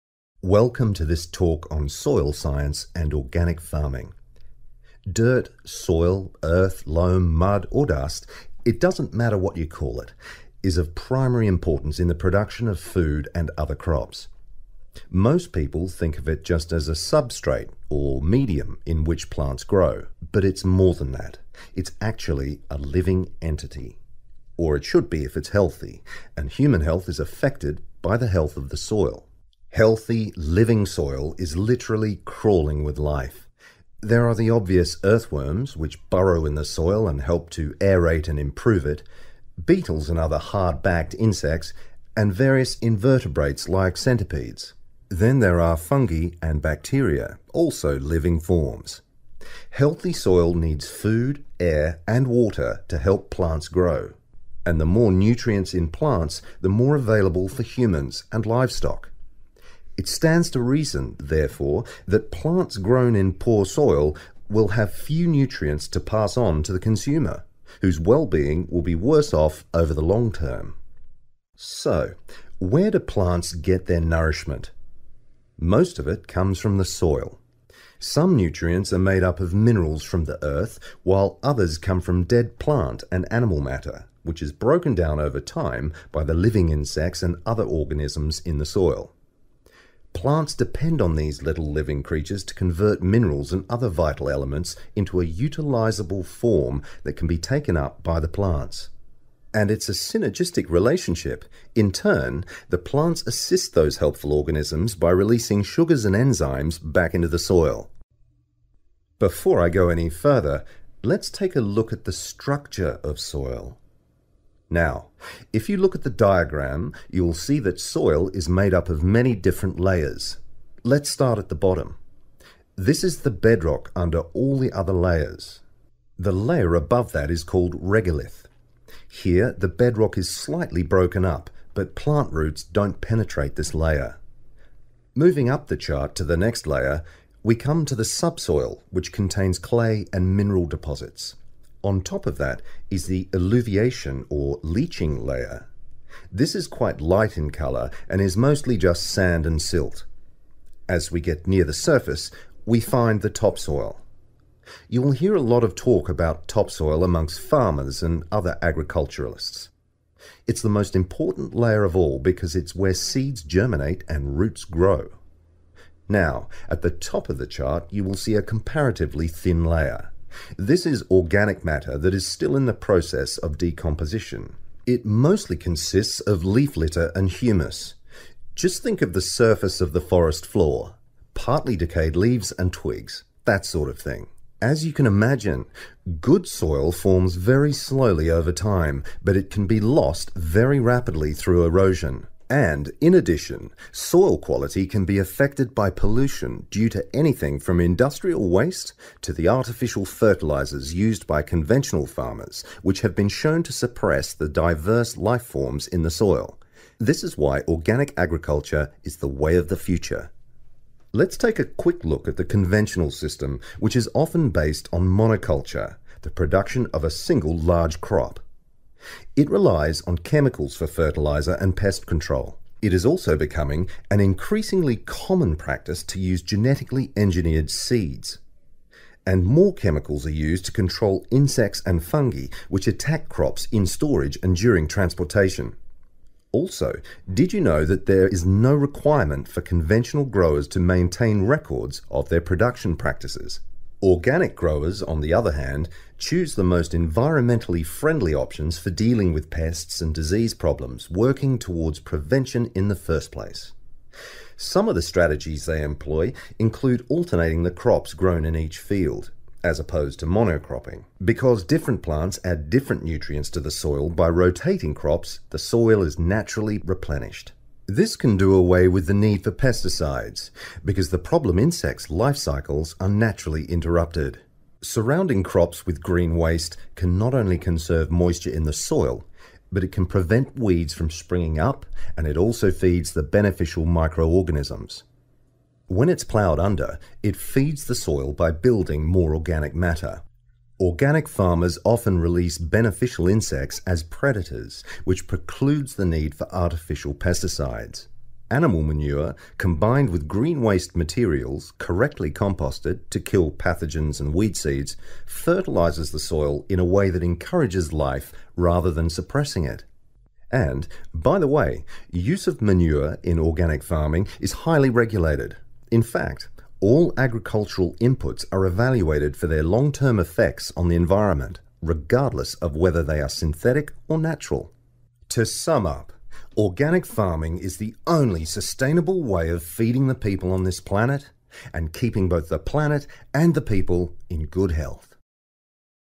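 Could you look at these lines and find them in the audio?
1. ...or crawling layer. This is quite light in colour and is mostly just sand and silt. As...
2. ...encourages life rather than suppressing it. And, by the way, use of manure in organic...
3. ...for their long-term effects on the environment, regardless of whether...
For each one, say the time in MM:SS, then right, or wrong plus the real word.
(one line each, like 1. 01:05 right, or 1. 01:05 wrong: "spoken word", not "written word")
1. 02:24 wrong: "leaching", not "crawling"
2. 05:07 right
3. 05:19 right.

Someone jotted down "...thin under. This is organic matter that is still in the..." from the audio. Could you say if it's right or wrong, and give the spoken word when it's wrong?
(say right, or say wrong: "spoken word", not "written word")
wrong: "layer", not "under".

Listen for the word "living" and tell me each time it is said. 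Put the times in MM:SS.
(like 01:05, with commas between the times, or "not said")
00:22, 00:30, 00:47, 01:26, 01:31.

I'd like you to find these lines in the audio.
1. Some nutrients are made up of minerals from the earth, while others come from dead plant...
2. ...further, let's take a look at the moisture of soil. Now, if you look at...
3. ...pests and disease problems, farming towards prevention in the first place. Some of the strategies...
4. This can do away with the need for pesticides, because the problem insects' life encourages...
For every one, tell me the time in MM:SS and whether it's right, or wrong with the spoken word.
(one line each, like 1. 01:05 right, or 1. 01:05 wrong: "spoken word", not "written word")
1. 01:17 right
2. 01:50 wrong: "structure", not "moisture"
3. 04:09 wrong: "working", not "farming"
4. 04:27 wrong: "cycles", not "encourages".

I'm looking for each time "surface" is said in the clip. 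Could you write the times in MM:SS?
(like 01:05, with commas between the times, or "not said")
02:31, 02:59.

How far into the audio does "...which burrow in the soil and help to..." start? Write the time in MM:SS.
00:35.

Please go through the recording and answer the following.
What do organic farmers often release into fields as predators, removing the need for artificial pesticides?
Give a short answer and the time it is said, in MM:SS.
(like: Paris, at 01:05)
beneficial insects, at 04:52.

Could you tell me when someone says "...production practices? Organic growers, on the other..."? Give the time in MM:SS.
04:02.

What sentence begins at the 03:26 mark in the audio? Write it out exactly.
This is why organic agriculture is the way of the future.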